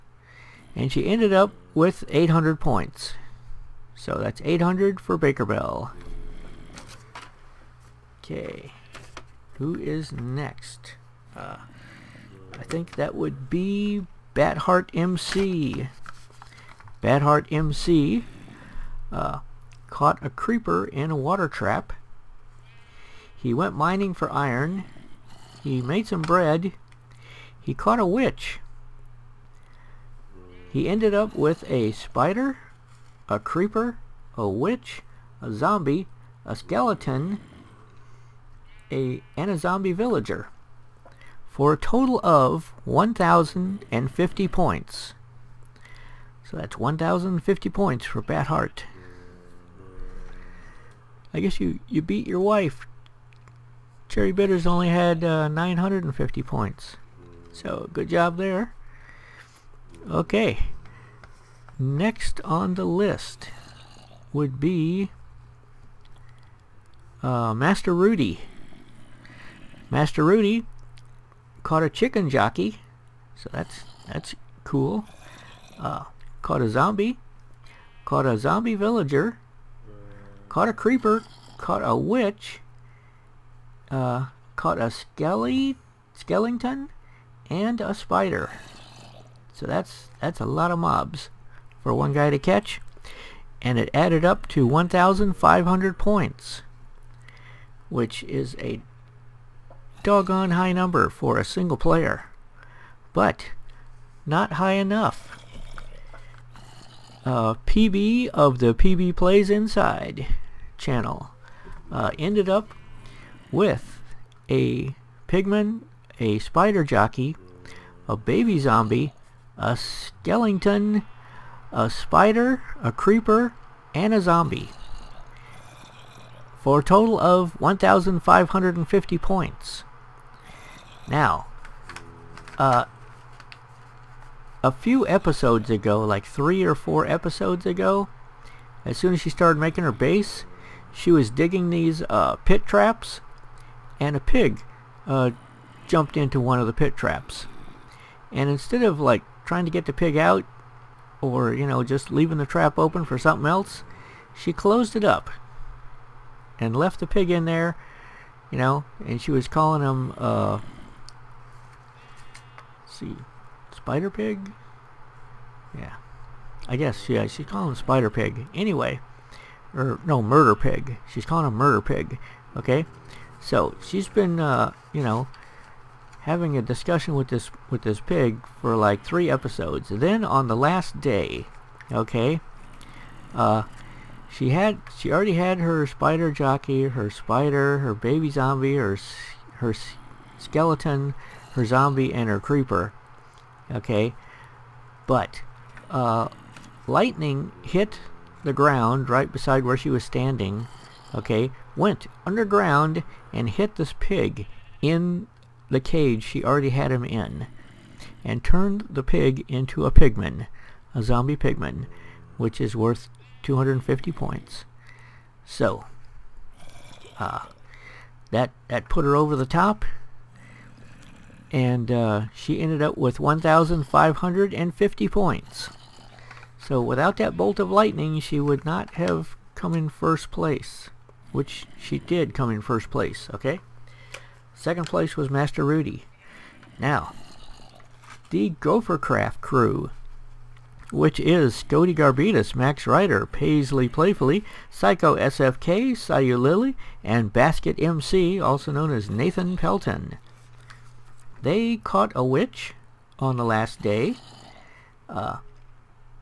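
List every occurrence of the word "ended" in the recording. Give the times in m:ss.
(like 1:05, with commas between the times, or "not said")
0:01, 0:30, 1:52, 3:42.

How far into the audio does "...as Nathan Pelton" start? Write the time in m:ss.
4:08.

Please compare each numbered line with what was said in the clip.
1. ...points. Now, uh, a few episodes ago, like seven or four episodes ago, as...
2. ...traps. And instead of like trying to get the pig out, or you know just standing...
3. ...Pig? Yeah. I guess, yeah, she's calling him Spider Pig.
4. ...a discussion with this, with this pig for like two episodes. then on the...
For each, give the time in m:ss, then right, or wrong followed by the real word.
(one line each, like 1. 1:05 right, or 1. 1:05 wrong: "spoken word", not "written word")
1. 2:09 wrong: "three", not "seven"
2. 2:26 wrong: "leaving", not "standing"
3. 2:44 right
4. 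2:56 wrong: "three", not "two".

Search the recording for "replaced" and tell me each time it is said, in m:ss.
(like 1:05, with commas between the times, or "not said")
not said.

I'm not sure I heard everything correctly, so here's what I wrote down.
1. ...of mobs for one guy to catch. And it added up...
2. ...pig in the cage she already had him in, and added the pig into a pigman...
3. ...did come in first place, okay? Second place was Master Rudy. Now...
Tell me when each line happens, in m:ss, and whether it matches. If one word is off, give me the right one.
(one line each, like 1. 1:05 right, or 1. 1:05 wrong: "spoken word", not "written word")
1. 1:30 right
2. 3:23 wrong: "turned", not "added"
3. 3:51 right.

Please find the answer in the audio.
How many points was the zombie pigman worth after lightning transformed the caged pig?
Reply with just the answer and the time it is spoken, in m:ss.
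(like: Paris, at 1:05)
250 points, at 3:33.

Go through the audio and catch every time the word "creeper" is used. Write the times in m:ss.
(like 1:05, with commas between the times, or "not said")
0:20, 0:33, 1:20, 2:02, 3:12.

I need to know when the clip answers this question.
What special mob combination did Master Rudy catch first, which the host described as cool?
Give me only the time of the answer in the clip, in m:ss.
1:11.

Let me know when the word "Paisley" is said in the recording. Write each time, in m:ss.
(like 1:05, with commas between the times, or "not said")
4:03.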